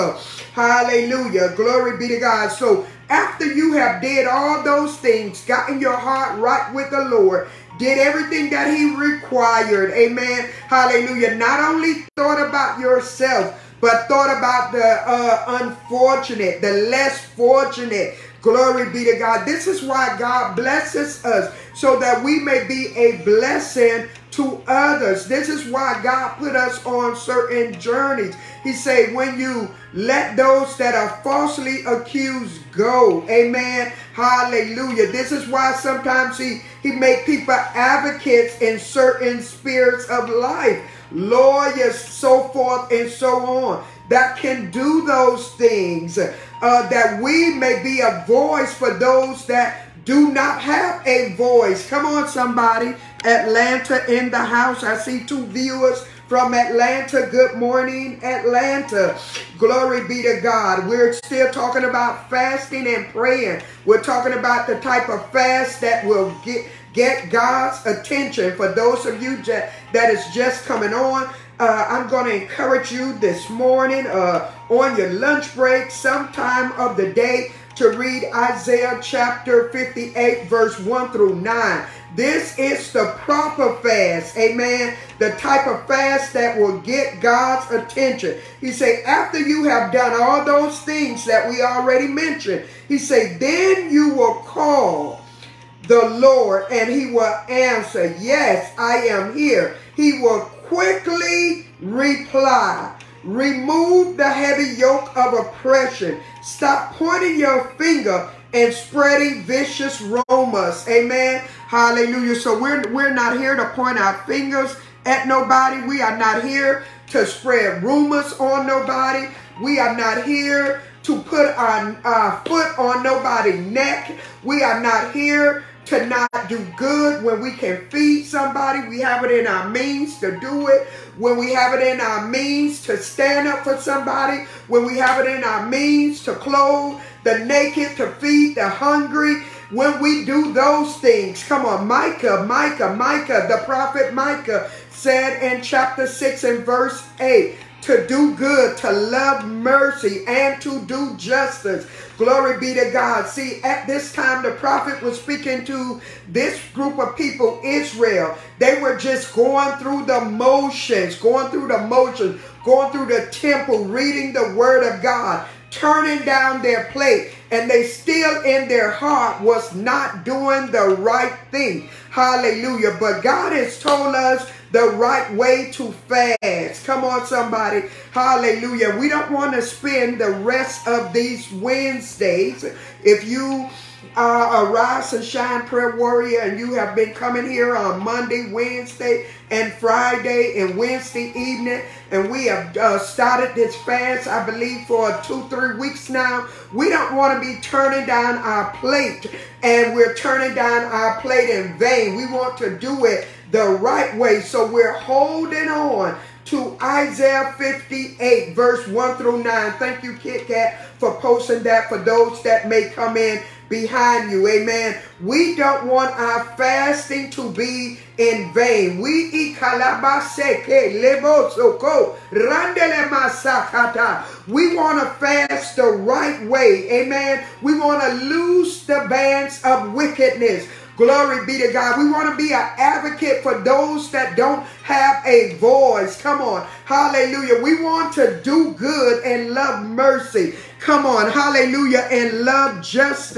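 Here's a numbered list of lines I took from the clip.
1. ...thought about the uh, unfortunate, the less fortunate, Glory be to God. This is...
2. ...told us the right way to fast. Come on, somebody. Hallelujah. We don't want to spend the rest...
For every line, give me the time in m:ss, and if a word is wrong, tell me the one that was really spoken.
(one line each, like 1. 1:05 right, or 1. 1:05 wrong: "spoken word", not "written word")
1. 0:14 right
2. 2:53 right.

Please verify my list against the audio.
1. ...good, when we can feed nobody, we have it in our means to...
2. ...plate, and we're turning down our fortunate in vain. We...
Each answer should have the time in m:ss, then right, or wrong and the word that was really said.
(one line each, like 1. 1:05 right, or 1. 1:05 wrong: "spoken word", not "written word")
1. 2:06 wrong: "somebody", not "nobody"
2. 3:18 wrong: "plate", not "fortunate".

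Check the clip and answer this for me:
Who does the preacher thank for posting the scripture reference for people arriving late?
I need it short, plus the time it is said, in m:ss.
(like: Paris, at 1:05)
Kit Kat, at 3:30.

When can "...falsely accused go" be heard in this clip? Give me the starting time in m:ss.
0:31.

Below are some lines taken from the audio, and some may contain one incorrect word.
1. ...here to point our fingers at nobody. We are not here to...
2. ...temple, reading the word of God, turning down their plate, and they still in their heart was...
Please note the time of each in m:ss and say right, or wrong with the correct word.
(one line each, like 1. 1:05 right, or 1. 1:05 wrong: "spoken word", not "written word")
1. 1:53 right
2. 2:43 right.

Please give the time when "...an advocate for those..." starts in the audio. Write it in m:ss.
3:52.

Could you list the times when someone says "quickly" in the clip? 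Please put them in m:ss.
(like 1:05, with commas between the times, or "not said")
1:40.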